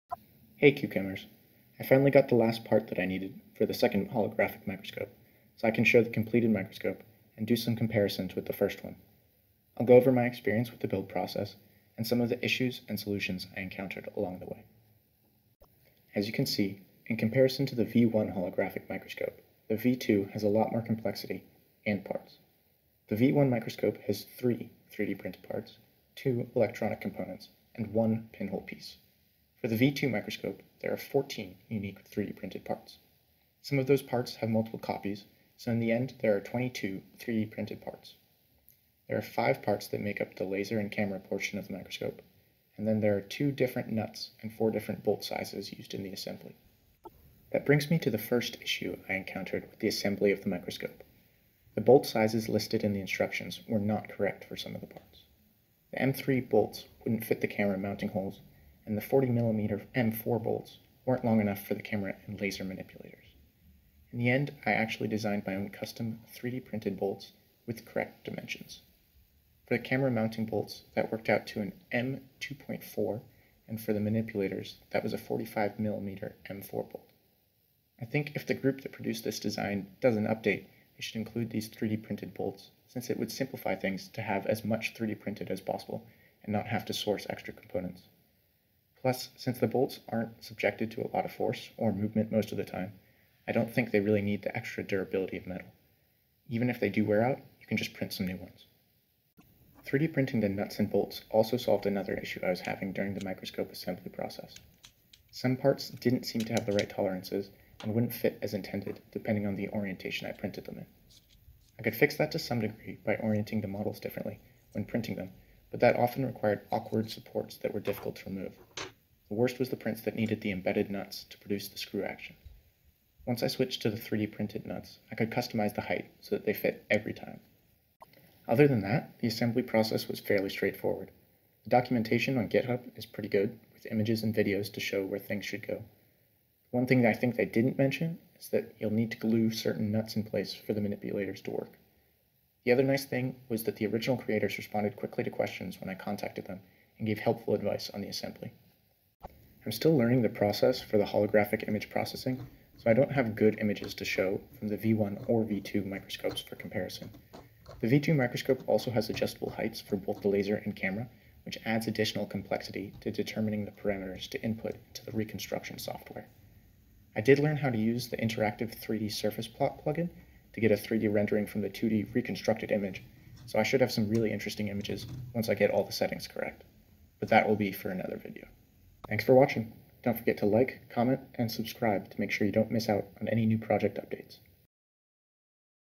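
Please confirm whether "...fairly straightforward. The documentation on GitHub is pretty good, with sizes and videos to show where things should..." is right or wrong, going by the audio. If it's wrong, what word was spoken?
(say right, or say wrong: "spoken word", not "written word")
wrong: "images", not "sizes".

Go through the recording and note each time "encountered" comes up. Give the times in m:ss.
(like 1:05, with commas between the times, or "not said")
0:13, 0:49.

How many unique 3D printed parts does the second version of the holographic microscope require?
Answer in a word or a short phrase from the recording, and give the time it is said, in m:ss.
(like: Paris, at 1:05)
14, at 0:30.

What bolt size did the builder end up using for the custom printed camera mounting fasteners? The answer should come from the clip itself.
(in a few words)
M2.4.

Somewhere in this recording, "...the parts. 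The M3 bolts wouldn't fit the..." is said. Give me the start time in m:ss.
0:54.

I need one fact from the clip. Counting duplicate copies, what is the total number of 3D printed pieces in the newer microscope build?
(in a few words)
22.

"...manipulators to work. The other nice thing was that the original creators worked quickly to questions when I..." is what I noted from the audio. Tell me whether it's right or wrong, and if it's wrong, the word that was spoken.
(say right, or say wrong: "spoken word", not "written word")
wrong: "responded", not "worked".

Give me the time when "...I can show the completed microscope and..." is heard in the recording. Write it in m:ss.
0:05.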